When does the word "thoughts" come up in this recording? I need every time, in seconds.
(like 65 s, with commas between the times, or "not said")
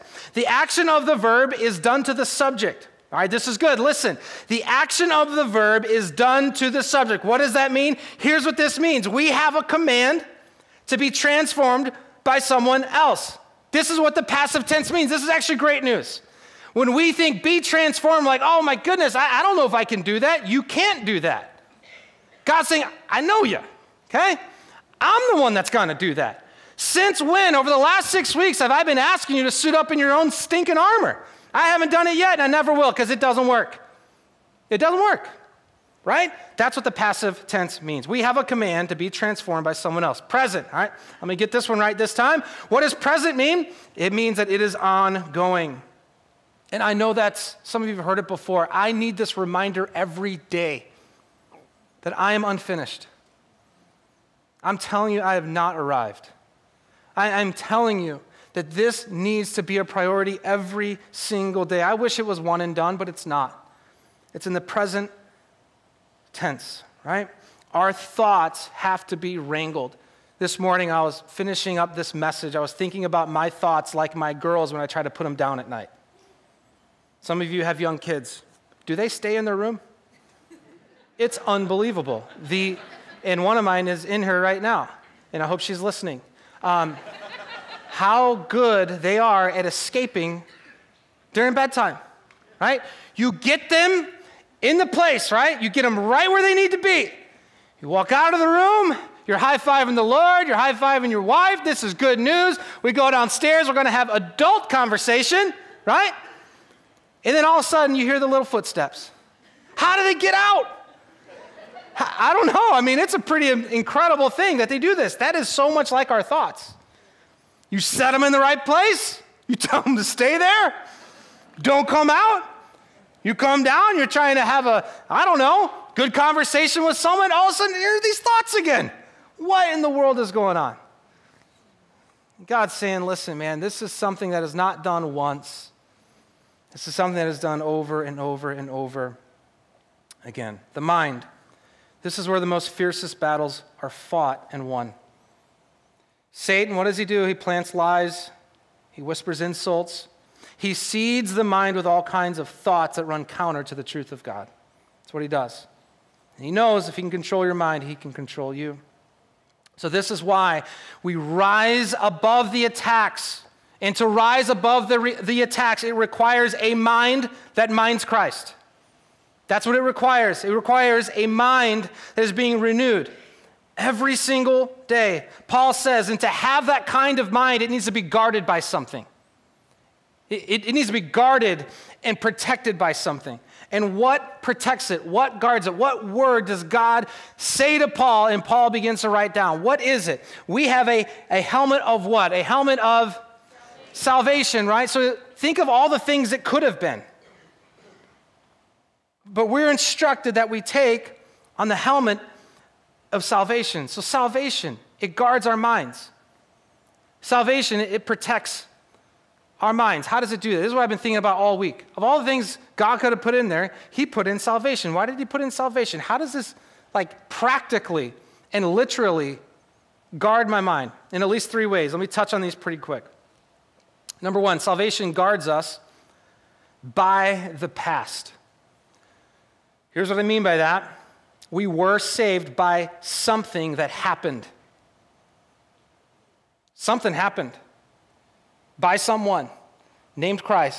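67 s, 73 s, 116 s, 128 s, 152 s.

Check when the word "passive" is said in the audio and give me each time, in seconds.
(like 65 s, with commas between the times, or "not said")
14 s, 36 s.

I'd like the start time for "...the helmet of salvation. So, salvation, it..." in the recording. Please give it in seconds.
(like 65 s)
201 s.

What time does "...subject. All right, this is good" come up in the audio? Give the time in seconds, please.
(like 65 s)
2 s.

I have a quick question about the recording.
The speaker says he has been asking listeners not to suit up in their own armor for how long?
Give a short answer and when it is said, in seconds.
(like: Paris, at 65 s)
Six weeks, at 28 s.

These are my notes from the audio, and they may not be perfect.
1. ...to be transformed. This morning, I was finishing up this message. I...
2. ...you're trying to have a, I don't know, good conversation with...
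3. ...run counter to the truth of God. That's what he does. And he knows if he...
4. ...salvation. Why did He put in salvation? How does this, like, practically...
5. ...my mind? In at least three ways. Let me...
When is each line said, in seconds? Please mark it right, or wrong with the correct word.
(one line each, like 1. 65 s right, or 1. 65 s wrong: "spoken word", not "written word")
1. 69 s wrong: "wrangled", not "transformed"
2. 123 s right
3. 153 s right
4. 214 s right
5. 220 s right.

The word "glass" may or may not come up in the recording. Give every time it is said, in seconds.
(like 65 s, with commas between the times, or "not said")
not said.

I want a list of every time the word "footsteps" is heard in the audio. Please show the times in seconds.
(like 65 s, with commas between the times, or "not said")
108 s.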